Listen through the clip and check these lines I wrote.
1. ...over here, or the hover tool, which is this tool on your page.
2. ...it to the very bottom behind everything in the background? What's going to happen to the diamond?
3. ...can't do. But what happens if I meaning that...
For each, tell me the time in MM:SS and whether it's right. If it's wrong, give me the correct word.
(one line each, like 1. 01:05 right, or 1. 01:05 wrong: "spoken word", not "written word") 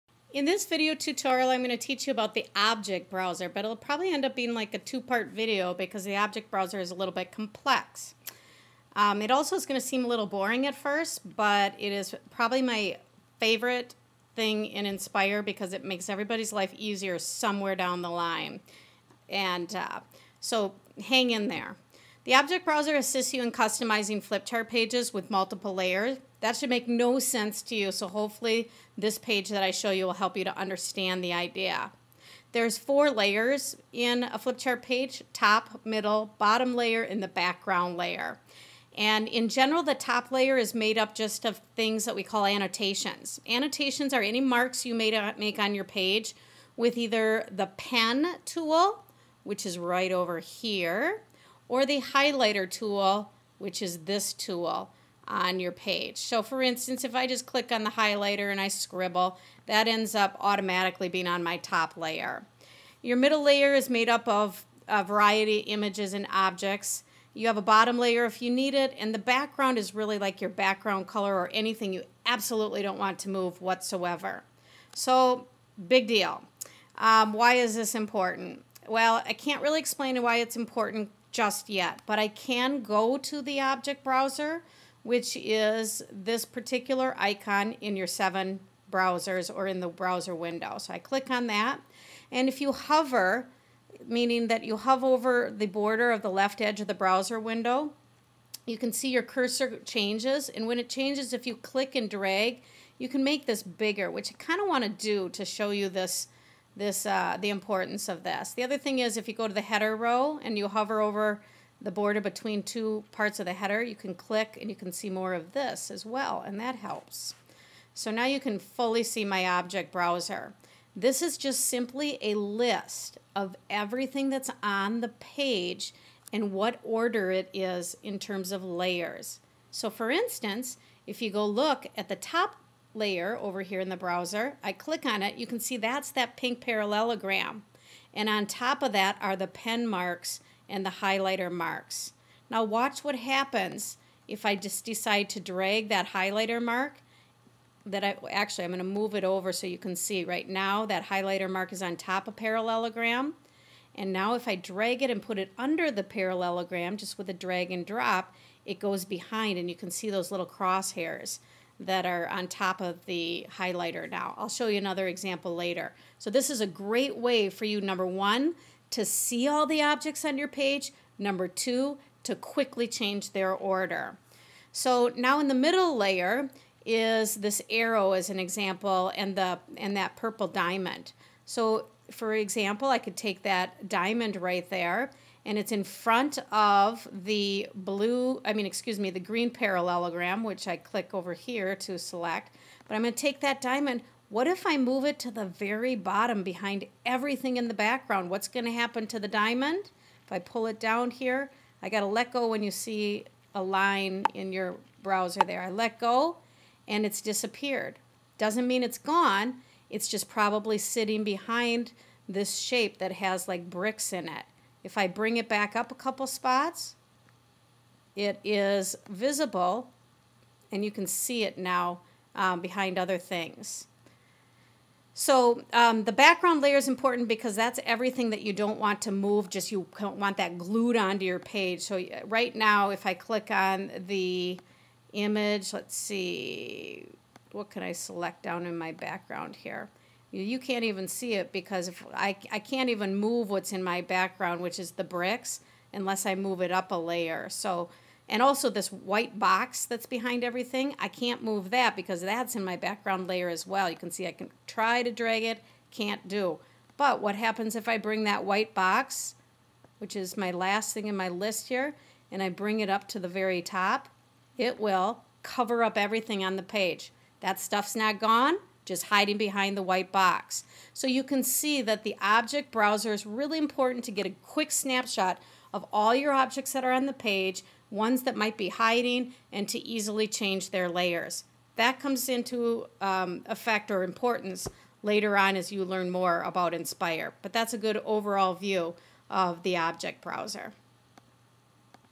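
1. 00:50 wrong: "highlighter", not "hover"
2. 03:15 right
3. 04:15 wrong: "bring", not "meaning".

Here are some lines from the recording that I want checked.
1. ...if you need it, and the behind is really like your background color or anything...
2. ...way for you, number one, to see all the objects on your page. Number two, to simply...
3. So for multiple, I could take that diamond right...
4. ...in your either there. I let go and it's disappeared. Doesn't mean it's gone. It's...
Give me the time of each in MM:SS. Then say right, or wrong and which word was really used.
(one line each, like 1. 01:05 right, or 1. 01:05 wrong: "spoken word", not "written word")
1. 01:08 wrong: "background", not "behind"
2. 02:47 wrong: "quickly", not "simply"
3. 03:01 wrong: "example", not "multiple"
4. 03:24 wrong: "browser", not "either".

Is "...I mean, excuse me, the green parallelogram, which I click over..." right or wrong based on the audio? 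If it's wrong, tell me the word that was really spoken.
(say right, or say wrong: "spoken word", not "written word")
right.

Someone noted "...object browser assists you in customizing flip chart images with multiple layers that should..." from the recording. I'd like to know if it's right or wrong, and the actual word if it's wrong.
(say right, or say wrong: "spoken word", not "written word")
wrong: "pages", not "images".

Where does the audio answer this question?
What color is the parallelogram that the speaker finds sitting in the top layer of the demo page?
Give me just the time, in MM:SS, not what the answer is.
02:16.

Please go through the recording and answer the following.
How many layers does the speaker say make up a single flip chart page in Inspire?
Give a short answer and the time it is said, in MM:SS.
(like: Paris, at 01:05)
4, at 00:32.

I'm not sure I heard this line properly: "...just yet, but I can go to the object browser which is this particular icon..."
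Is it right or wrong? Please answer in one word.
right.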